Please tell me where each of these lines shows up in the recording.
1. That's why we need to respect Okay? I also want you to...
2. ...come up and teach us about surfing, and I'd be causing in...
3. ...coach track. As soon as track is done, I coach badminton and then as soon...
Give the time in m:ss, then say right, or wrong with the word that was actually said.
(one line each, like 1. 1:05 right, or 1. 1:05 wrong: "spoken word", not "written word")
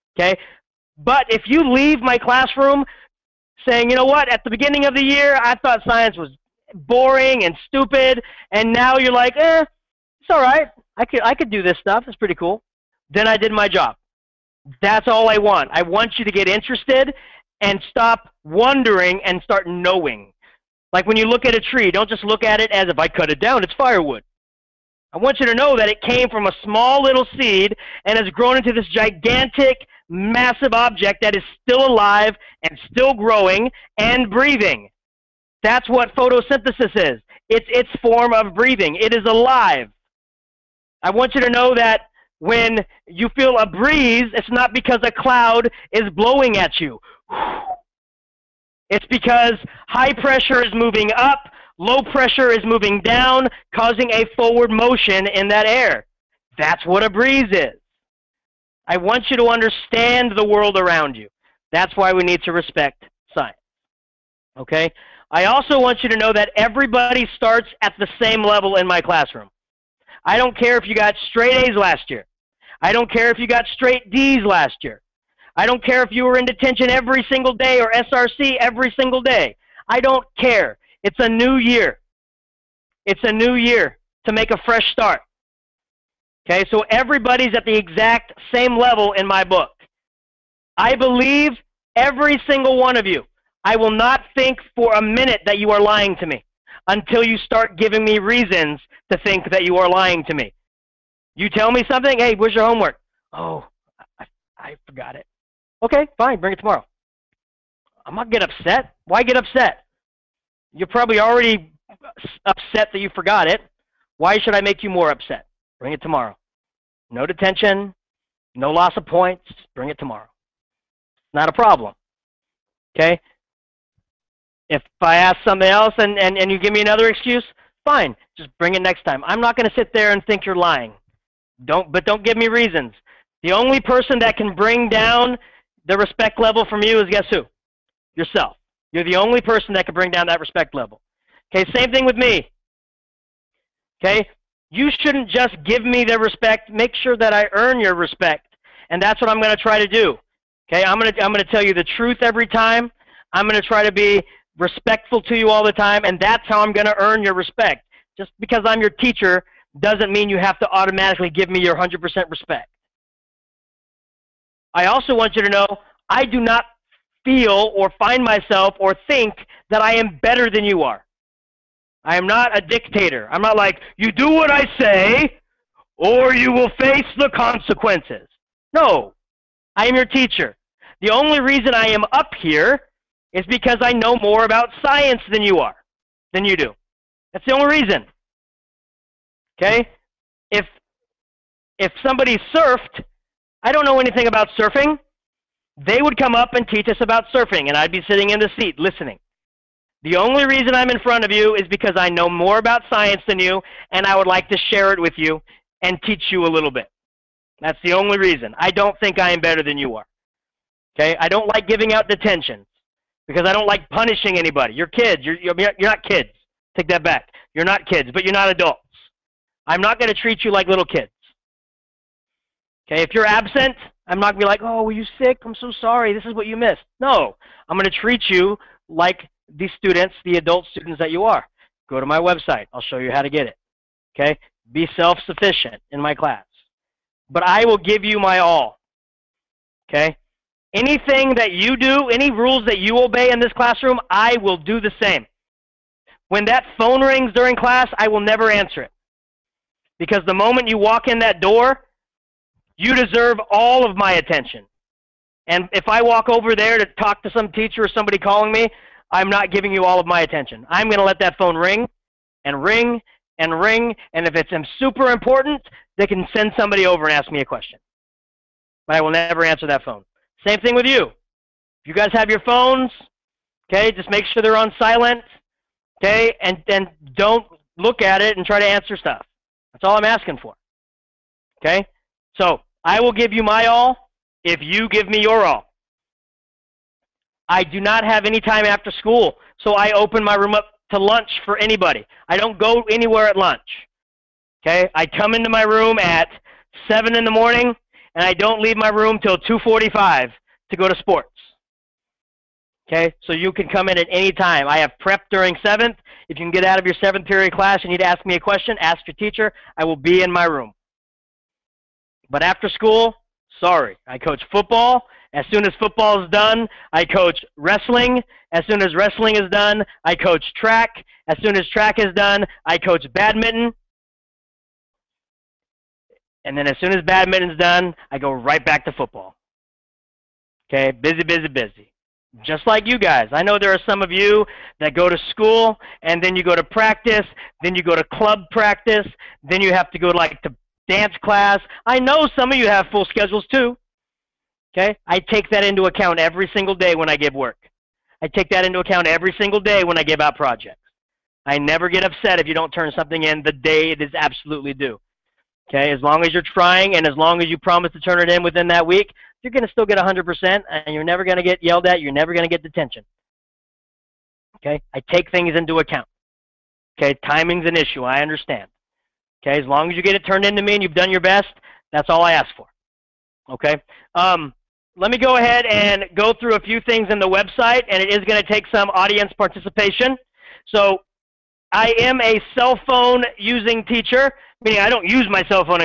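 1. 1:01 right
2. 3:16 wrong: "sitting", not "causing"
3. 5:20 right.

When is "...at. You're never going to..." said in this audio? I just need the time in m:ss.
6:01.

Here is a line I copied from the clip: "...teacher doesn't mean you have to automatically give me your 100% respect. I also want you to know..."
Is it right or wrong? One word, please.
right.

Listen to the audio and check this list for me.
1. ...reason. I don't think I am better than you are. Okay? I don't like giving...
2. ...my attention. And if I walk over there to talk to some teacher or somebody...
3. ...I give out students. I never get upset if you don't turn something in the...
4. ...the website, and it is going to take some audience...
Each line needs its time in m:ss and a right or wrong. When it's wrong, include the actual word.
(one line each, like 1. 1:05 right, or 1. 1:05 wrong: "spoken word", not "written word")
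1. 3:28 right
2. 4:13 right
3. 5:49 wrong: "projects", not "students"
4. 6:17 right.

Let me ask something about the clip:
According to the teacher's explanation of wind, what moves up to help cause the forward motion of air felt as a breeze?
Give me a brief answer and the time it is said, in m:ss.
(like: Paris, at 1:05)
High pressure, at 0:49.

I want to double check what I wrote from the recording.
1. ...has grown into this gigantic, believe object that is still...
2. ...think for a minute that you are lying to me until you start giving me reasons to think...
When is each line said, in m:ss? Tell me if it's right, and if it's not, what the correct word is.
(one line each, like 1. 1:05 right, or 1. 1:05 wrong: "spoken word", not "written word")
1. 0:28 wrong: "massive", not "believe"
2. 1:34 right.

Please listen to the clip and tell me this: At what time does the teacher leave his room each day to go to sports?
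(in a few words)
2:45.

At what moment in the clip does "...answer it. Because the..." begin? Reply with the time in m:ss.
4:08.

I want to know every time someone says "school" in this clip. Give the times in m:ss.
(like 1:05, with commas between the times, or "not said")
4:48, 5:12, 5:35.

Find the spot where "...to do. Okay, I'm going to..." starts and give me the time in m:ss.
2:29.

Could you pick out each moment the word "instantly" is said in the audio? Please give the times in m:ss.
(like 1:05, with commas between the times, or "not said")
not said.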